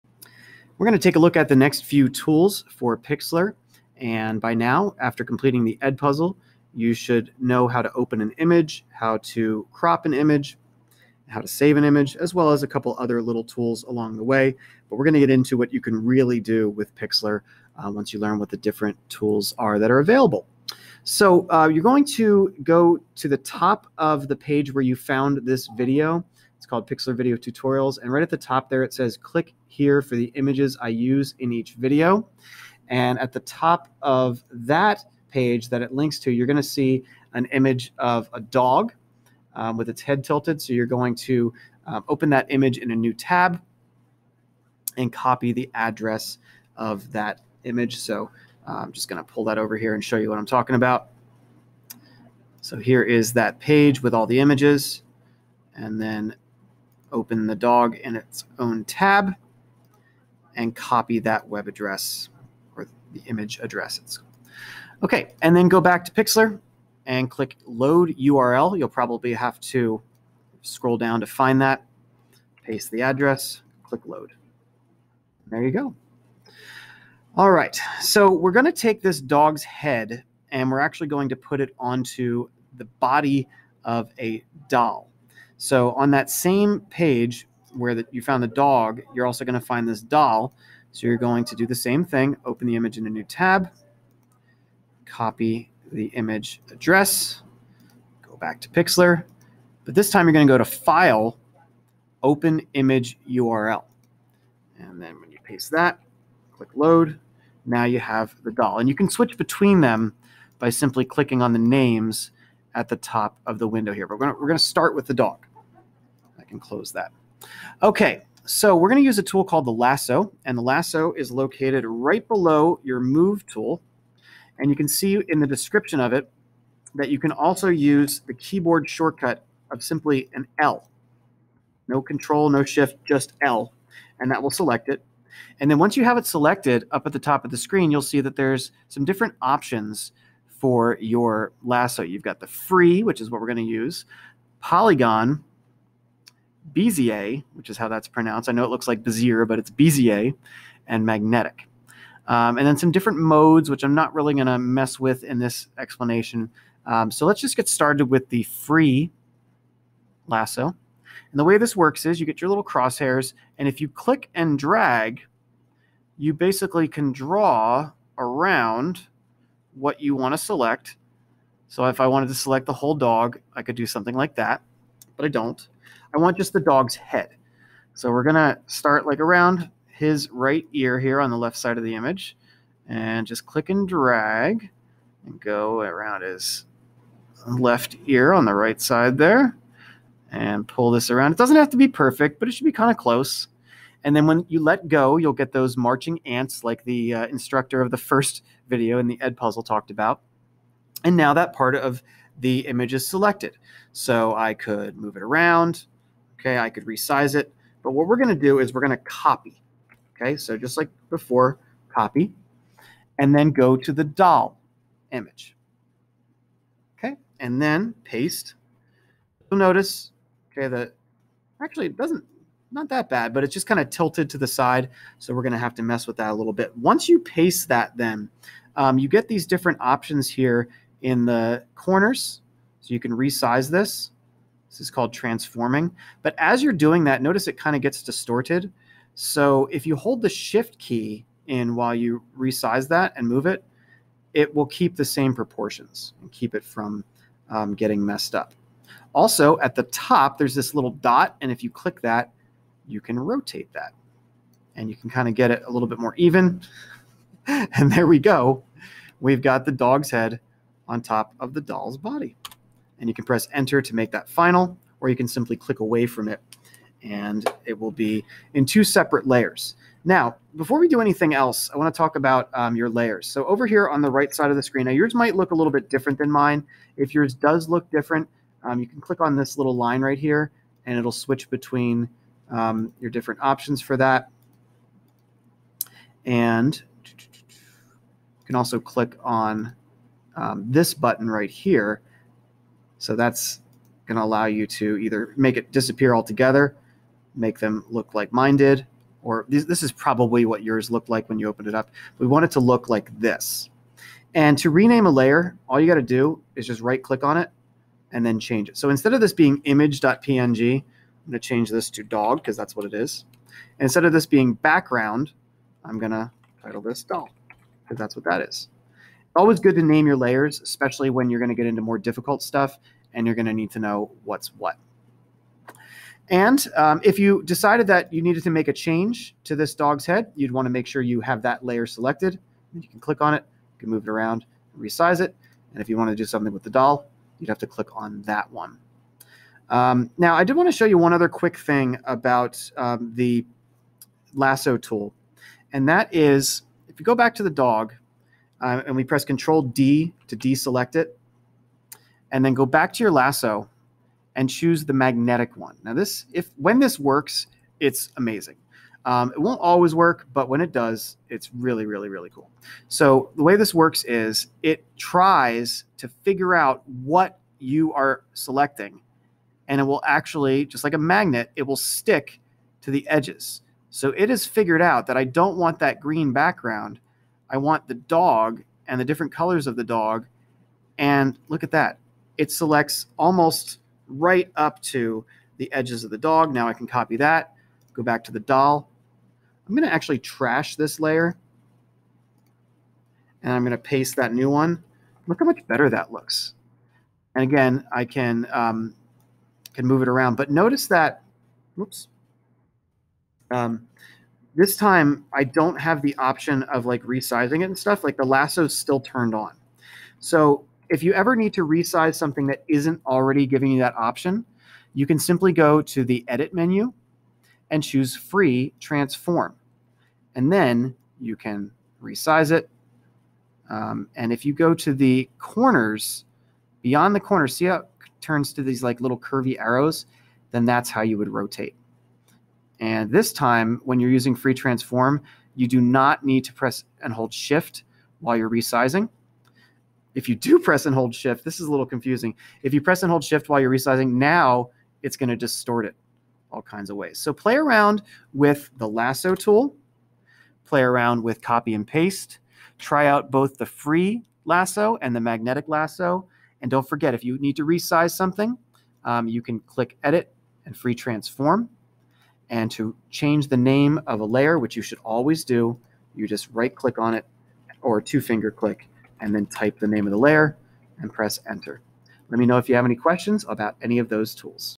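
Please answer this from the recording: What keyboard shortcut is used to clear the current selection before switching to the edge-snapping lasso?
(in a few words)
Control D.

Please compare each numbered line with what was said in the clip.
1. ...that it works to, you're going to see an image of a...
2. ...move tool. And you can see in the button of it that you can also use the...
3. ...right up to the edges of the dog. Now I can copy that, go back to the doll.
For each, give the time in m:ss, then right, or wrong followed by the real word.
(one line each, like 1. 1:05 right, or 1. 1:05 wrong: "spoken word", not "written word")
1. 0:35 wrong: "links", not "works"
2. 2:02 wrong: "description", not "button"
3. 6:24 right.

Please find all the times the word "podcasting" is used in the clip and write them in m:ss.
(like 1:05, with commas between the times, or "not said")
not said.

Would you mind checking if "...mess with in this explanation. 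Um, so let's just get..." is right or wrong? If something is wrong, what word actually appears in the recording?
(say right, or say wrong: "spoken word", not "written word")
right.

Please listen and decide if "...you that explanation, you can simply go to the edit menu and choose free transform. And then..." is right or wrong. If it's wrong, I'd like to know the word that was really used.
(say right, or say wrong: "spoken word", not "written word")
wrong: "option", not "explanation".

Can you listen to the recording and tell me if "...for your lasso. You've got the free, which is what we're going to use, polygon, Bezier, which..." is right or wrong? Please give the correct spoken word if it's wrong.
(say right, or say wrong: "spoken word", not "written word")
right.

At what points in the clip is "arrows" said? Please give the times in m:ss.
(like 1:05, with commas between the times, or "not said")
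7:09.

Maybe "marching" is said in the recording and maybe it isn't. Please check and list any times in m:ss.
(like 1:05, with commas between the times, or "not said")
3:15.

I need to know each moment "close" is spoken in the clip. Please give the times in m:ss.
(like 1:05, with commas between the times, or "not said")
1:56, 3:12.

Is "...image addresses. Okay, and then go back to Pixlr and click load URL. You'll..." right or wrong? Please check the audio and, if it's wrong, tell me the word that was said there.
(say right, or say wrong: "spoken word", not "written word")
right.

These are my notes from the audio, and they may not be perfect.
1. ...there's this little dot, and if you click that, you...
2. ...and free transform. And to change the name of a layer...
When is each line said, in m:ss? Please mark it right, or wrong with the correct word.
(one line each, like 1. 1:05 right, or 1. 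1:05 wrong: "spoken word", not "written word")
1. 4:10 right
2. 7:40 right.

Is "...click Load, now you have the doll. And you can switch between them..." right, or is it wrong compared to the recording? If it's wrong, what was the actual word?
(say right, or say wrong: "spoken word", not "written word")
right.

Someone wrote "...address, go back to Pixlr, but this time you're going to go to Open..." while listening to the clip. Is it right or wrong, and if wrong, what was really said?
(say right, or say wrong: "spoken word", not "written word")
wrong: "File", not "Open".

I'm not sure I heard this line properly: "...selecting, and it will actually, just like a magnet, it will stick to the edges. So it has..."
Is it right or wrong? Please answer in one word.
right.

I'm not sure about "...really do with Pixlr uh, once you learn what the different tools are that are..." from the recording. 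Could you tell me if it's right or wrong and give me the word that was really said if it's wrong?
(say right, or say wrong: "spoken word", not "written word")
right.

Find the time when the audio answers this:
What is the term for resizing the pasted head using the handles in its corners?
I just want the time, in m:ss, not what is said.
3:55.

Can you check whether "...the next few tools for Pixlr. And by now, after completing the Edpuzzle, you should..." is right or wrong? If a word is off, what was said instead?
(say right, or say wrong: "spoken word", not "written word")
right.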